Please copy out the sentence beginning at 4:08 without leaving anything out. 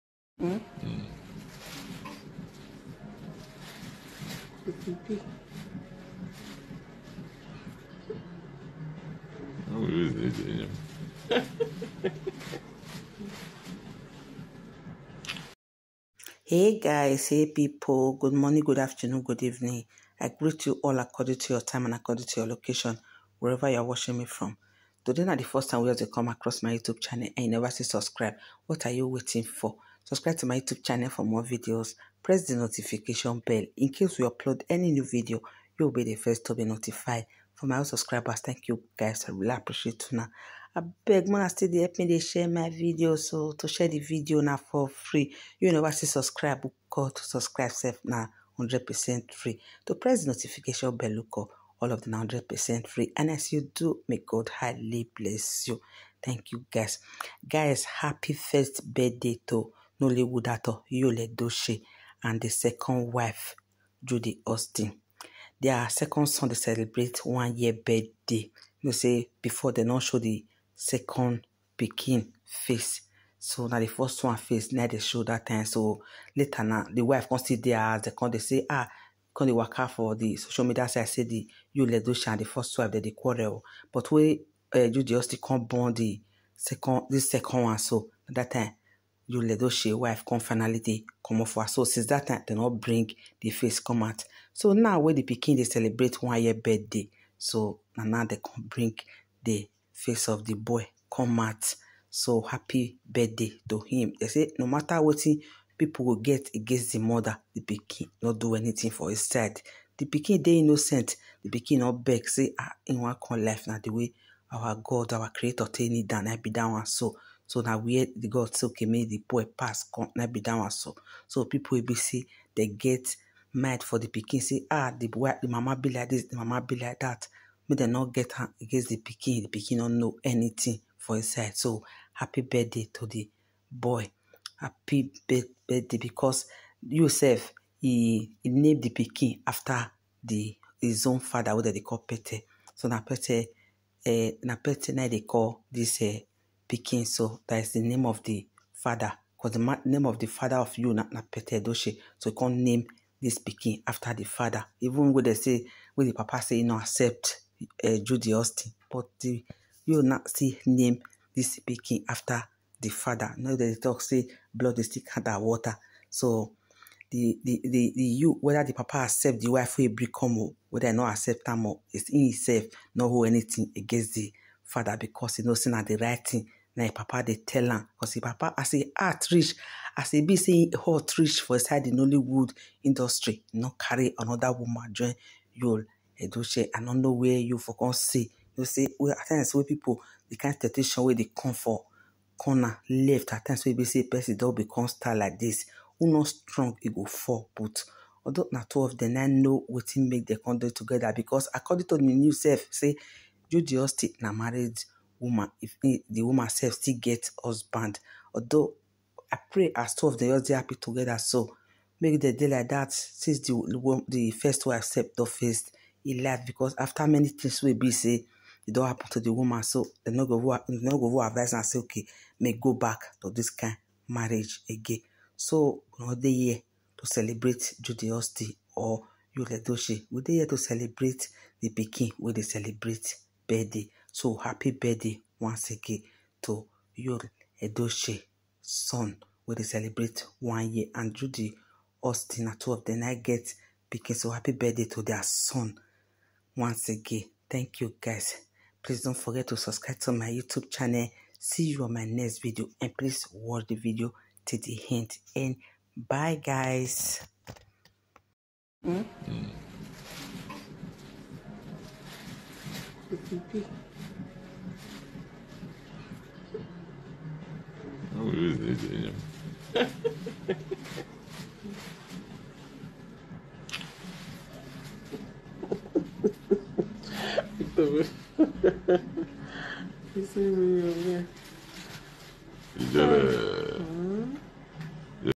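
Please don't forget to subscribe to my YouTube channel.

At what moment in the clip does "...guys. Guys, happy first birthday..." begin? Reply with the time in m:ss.
0:56.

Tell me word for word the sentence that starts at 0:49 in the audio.
To press the notification bell, look oh up all of the 100% free.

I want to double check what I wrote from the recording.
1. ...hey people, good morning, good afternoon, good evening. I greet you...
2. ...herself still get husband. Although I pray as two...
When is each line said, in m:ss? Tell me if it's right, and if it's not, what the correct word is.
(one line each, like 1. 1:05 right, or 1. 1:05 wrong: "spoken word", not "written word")
1. 0:17 right
2. 3:26 right.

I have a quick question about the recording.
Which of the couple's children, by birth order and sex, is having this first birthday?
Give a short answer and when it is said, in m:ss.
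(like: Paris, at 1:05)
second son, at 1:05.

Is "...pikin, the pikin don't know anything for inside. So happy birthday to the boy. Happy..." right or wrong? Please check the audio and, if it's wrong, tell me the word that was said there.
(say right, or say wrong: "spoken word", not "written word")
right.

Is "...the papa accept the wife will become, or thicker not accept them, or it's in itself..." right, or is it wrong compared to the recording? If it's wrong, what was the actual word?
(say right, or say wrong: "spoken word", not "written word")
wrong: "whether", not "thicker".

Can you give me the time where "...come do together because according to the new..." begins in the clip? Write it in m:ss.
3:20.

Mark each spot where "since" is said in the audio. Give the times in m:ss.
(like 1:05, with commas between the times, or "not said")
1:31, 3:32.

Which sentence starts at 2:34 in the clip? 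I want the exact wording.
Even when they say, when the papa say, you know, accept uh, eh, Judy Austin.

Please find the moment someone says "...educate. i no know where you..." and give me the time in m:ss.
3:06.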